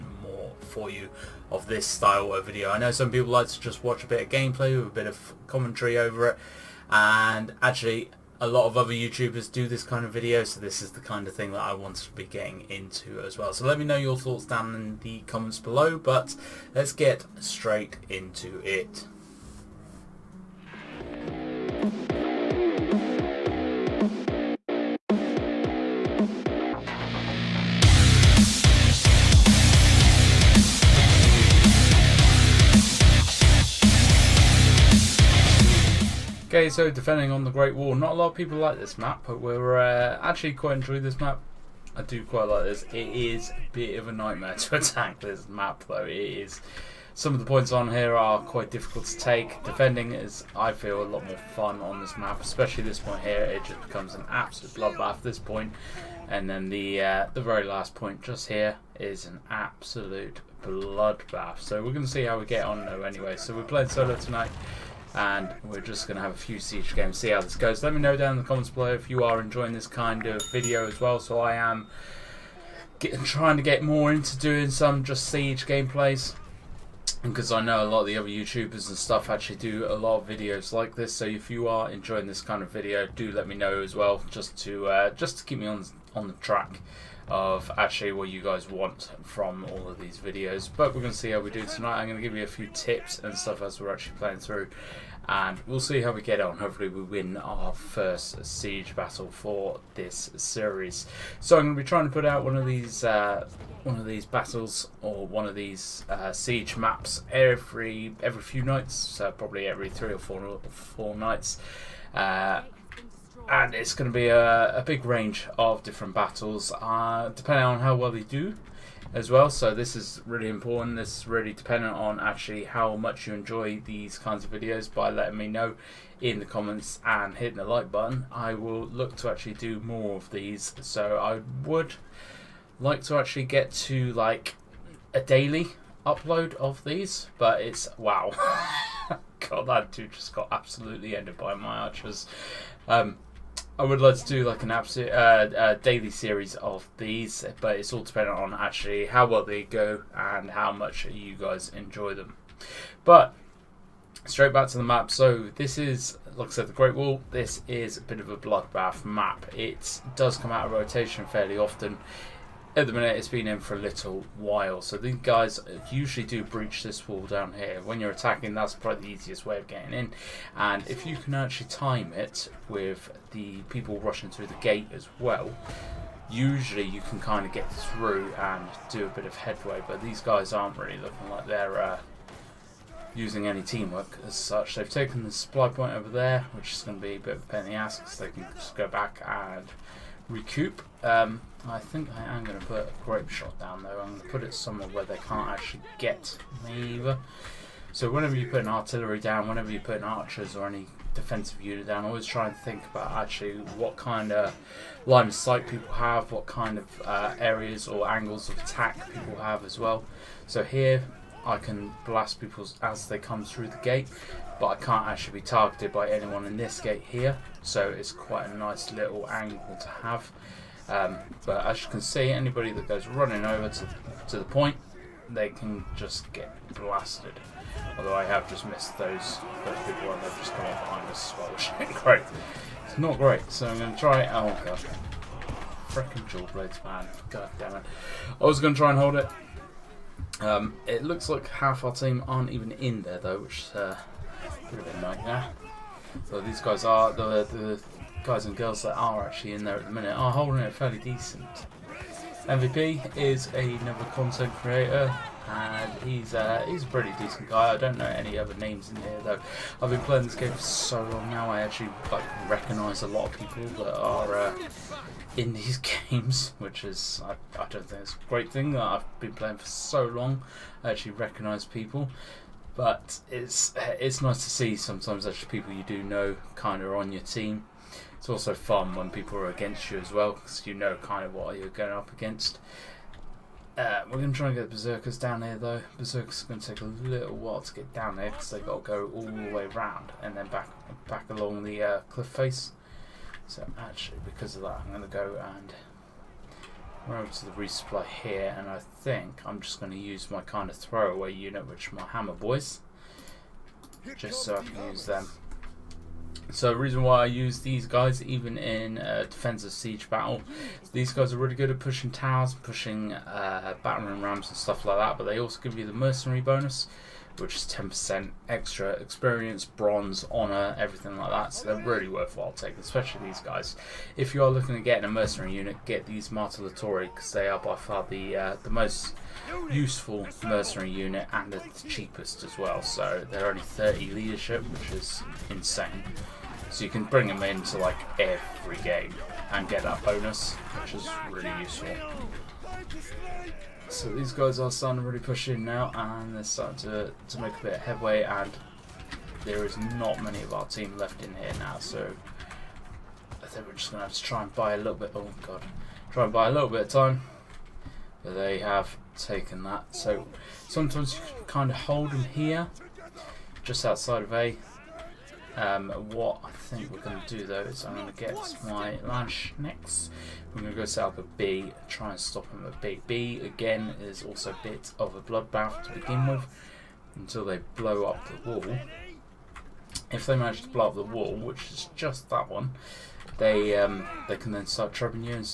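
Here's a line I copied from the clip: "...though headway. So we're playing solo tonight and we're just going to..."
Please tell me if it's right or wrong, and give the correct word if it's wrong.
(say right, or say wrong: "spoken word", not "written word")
wrong: "anyway", not "headway".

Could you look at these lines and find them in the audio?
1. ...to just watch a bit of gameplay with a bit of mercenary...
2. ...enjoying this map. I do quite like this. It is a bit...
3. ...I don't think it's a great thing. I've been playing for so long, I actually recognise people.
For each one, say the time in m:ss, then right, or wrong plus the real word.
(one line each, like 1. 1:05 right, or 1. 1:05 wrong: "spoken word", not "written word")
1. 0:03 wrong: "commentary", not "mercenary"
2. 0:40 right
3. 4:27 right.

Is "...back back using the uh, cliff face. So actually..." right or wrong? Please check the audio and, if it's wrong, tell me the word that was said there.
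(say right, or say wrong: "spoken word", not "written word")
wrong: "along", not "using".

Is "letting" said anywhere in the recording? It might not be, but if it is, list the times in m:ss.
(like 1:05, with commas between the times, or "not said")
2:05.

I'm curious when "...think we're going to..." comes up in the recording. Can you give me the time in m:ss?
6:06.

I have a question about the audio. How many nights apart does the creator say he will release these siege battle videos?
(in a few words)
every 3 or 4 nights.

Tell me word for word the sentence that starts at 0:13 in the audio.
So let me know your thoughts down in the comments below, but let's get straight into it.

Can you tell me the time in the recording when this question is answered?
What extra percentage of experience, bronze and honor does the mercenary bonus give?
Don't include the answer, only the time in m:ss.
5:17.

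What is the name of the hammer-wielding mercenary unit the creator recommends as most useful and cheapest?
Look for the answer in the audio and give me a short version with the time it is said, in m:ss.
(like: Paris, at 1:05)
Martellatori, at 5:26.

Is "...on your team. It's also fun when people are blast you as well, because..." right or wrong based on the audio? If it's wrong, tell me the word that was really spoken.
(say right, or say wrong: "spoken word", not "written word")
wrong: "against", not "blast".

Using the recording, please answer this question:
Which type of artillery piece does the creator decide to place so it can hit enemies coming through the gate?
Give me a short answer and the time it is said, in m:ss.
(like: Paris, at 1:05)
grape shot, at 3:13.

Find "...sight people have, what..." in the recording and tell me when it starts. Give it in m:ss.
3:25.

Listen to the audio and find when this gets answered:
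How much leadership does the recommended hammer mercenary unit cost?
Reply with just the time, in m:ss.
5:33.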